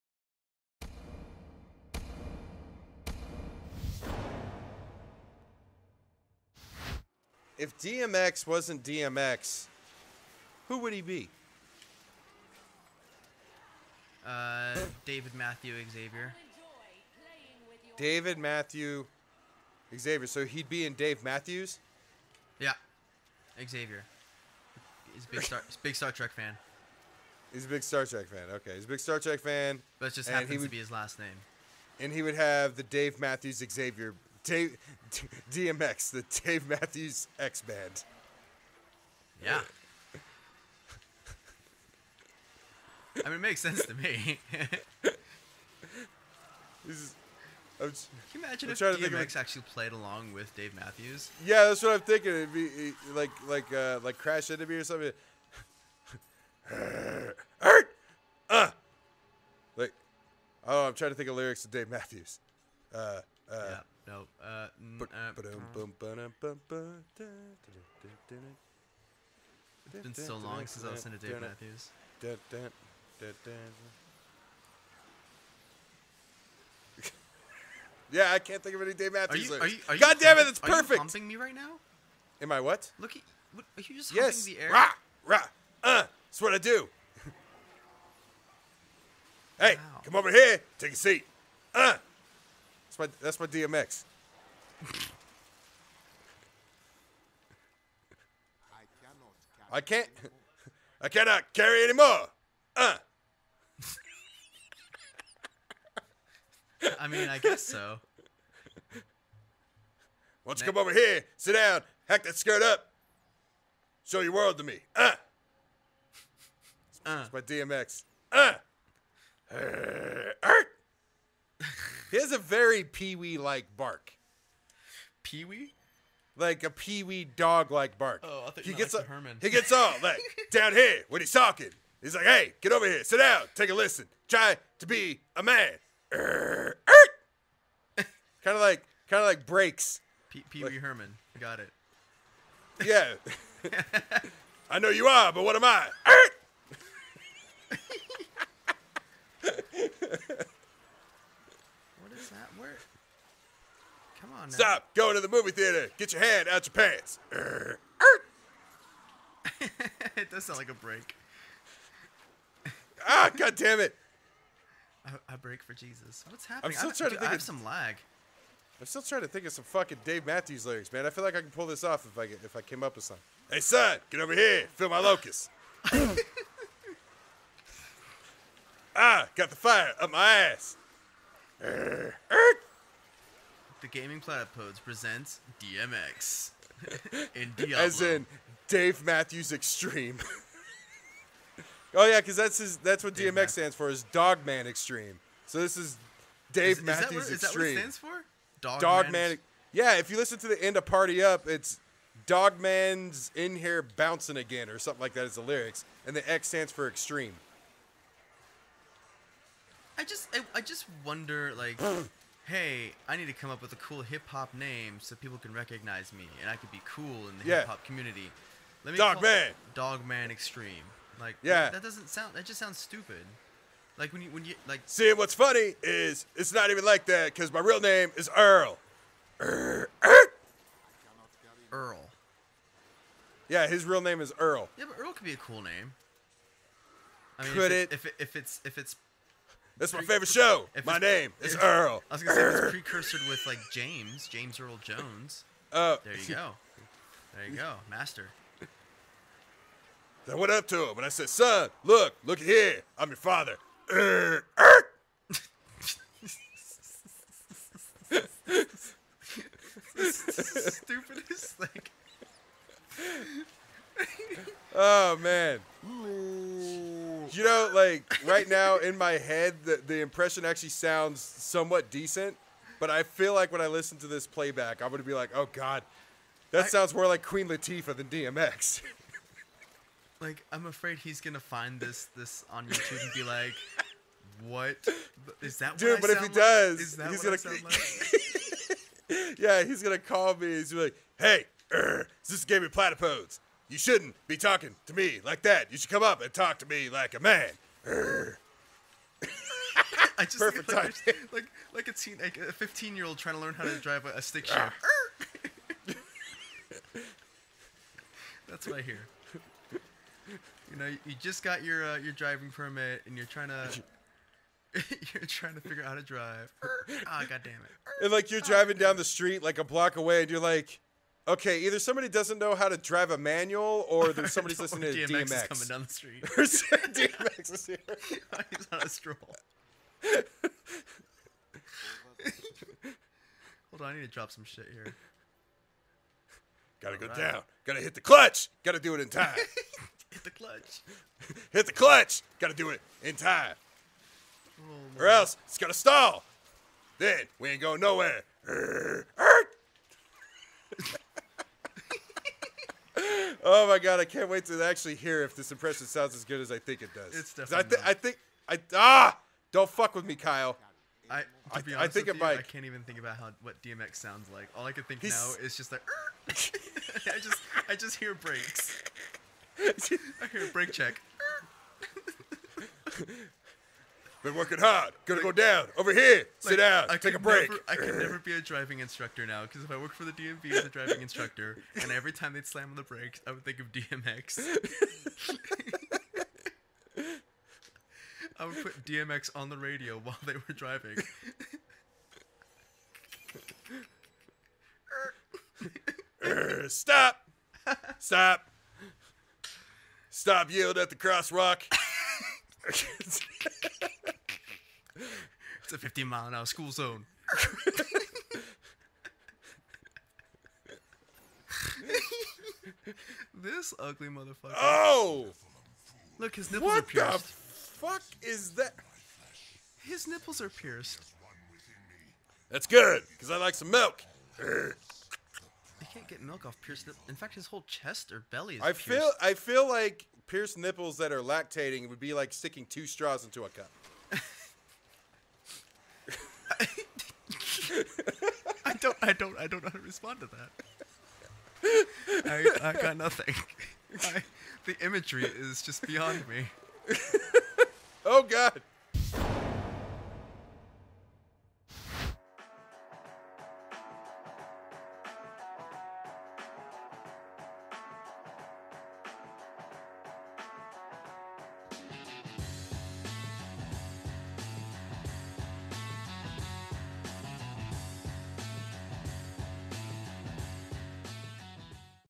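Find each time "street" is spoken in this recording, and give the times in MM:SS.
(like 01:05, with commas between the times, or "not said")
05:19, 05:25.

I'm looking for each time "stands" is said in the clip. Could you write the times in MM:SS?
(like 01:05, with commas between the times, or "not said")
03:13, 03:17, 03:26.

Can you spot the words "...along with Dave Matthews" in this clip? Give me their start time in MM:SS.
00:49.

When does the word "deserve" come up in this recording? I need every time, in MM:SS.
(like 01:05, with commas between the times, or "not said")
not said.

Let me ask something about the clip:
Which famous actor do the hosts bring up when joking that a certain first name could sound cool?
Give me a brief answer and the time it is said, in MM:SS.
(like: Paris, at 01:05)
James Earl Jones, at 04:04.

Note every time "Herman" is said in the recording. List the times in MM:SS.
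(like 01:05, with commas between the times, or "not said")
02:09, 02:20.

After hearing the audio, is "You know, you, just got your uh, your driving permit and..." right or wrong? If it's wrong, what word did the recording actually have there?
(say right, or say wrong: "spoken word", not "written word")
right.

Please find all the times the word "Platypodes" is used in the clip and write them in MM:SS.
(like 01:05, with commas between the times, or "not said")
03:04, 04:52.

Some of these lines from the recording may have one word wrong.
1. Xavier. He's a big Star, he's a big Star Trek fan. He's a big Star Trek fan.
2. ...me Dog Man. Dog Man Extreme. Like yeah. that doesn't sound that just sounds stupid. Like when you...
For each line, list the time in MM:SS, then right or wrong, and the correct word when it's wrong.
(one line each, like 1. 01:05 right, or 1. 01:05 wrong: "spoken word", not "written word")
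1. 00:23 right
2. 03:38 right.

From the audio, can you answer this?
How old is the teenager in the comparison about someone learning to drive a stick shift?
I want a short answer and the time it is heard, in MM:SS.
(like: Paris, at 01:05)
15, at 05:02.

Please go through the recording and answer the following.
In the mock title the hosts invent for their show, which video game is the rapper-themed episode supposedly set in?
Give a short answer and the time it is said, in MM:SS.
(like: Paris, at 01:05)
Diablo, at 03:07.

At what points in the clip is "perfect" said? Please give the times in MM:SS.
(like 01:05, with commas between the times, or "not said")
01:20, 05:00.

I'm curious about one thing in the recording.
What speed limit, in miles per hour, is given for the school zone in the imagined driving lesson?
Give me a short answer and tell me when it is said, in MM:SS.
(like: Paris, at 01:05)
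15, at 06:45.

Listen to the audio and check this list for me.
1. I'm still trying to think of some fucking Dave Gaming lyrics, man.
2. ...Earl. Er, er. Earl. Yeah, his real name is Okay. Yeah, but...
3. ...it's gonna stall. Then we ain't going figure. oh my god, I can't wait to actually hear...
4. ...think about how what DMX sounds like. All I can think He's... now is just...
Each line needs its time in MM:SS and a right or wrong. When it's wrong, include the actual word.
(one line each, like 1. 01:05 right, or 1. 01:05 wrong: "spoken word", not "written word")
1. 02:48 wrong: "Matthews", not "Gaming"
2. 03:48 wrong: "Earl", not "Okay"
3. 05:45 wrong: "nowhere", not "figure"
4. 06:02 right.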